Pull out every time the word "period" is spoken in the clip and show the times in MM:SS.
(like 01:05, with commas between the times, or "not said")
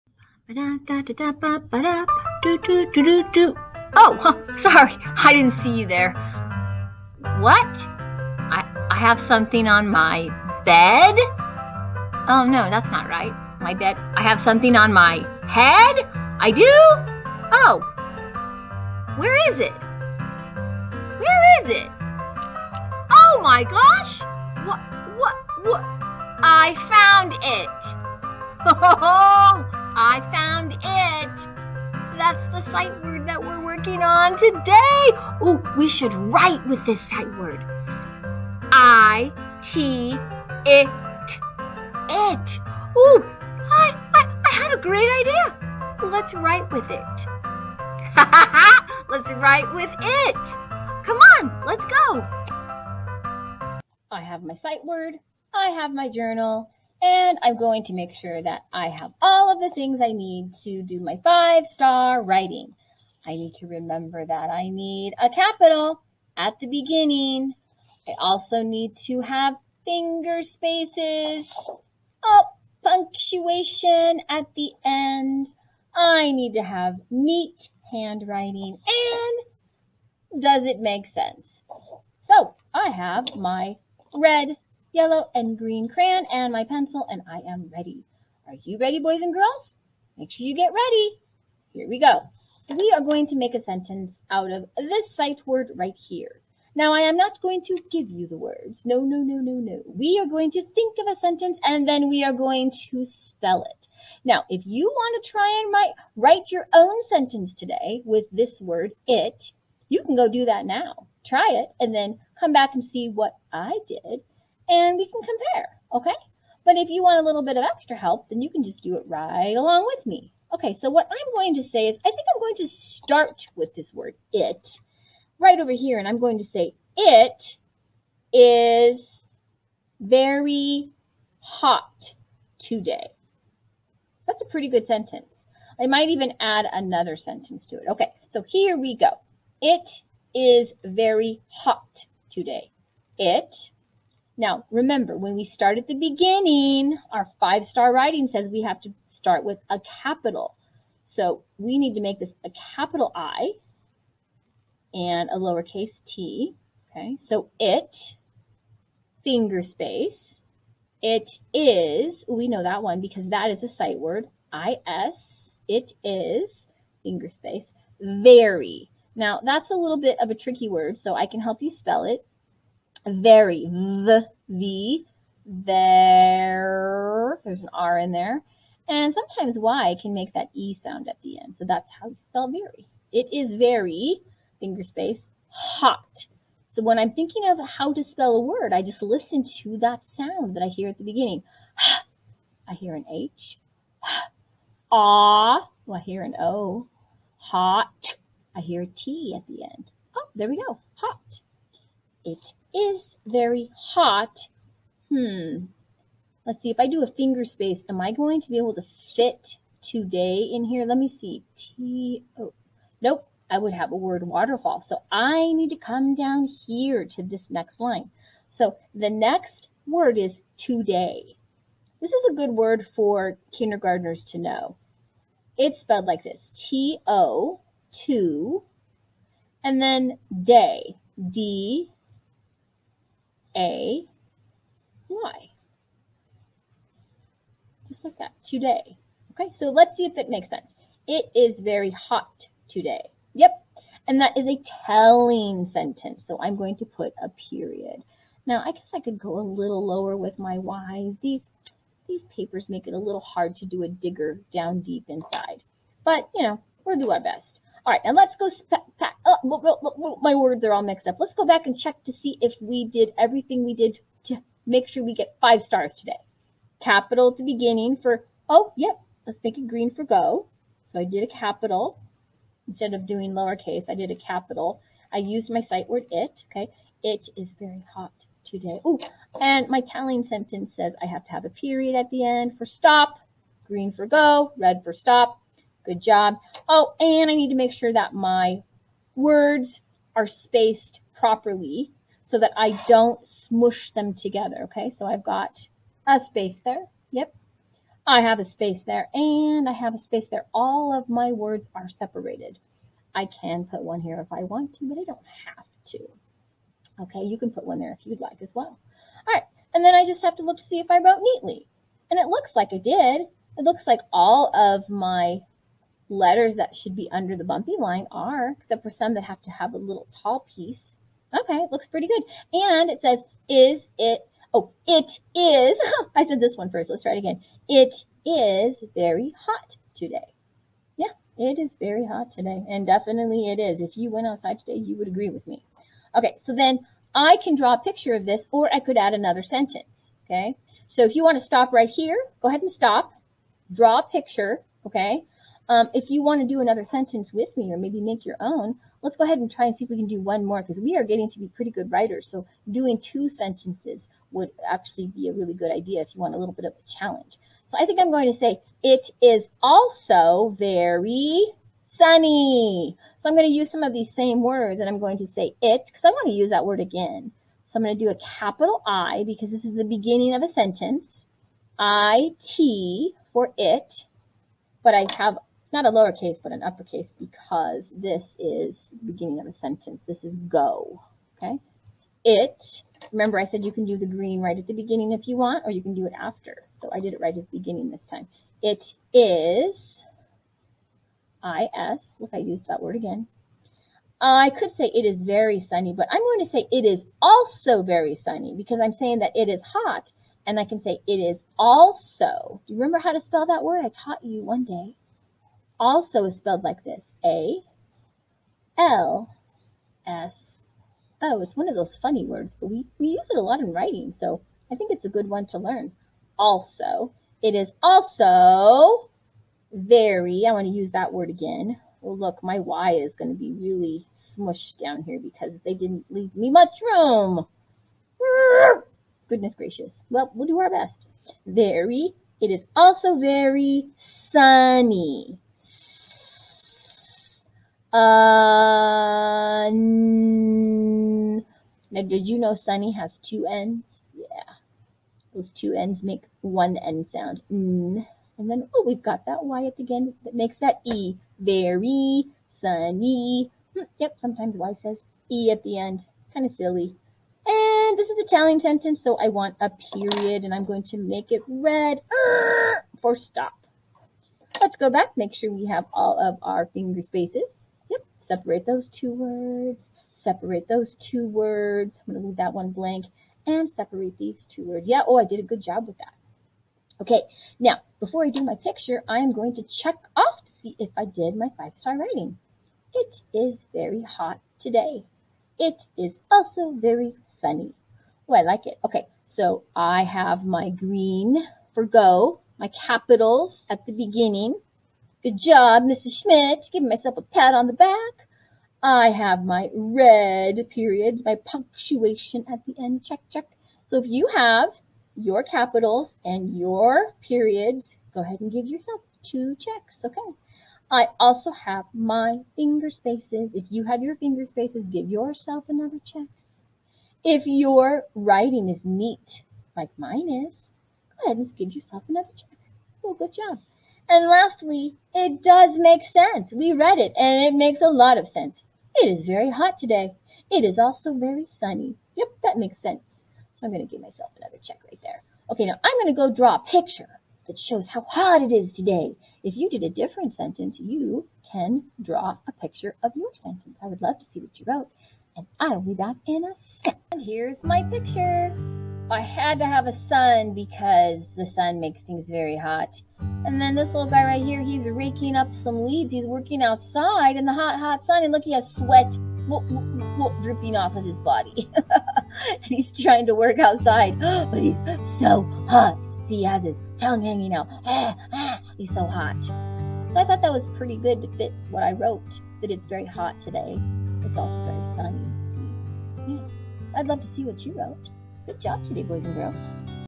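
04:07, 04:41, 07:39, 08:20, 08:27.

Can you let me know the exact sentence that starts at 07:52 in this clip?
I'm gonna leave that one blank and separate these two words.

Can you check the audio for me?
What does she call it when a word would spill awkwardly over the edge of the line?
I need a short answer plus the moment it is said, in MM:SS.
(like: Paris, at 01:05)
word waterfall, at 03:33.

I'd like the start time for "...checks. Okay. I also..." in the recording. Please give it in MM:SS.
08:29.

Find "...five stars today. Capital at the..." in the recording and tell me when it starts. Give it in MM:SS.
04:25.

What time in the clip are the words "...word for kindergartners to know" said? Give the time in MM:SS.
03:42.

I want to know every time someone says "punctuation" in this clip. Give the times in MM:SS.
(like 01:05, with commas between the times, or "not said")
01:12, 08:21.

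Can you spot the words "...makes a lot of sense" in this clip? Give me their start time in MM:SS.
08:47.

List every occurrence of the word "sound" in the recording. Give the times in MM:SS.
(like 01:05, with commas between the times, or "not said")
03:00, 03:10, 07:27.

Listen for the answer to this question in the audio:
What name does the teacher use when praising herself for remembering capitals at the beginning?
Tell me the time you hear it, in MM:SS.
08:15.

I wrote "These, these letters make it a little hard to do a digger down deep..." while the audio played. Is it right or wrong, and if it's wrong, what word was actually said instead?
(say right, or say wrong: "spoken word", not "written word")
wrong: "papers", not "letters".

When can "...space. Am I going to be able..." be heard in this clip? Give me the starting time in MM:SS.
03:27.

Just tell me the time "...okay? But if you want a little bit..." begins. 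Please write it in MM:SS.
01:55.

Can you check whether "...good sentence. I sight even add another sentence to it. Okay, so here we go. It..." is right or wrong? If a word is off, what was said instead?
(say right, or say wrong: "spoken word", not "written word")
wrong: "might", not "sight".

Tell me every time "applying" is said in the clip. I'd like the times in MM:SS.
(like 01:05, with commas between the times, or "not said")
not said.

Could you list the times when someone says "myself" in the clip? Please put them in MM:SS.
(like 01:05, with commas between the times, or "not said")
08:16, 08:54.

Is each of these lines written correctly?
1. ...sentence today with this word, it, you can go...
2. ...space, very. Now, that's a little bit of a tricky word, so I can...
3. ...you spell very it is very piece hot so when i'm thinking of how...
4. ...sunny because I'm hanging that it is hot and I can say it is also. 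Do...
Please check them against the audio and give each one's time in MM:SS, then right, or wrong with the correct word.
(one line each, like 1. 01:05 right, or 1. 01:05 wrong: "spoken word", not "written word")
1. 01:47 right
2. 02:47 right
3. 03:02 wrong: "fingerspace", not "piece"
4. 06:38 wrong: "saying", not "hanging".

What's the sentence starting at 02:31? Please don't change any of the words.
So we need to make this a capital I and a lowercase t.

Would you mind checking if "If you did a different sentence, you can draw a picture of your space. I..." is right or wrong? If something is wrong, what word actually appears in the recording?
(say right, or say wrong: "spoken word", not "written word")
wrong: "sentence", not "space".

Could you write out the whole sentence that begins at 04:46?
Oh, and I need to make sure that my words are spaced properly so that I don't smush them together.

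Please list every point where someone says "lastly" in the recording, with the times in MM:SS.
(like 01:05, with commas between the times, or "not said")
08:44.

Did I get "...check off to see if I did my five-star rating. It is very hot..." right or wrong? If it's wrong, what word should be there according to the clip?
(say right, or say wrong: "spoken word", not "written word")
right.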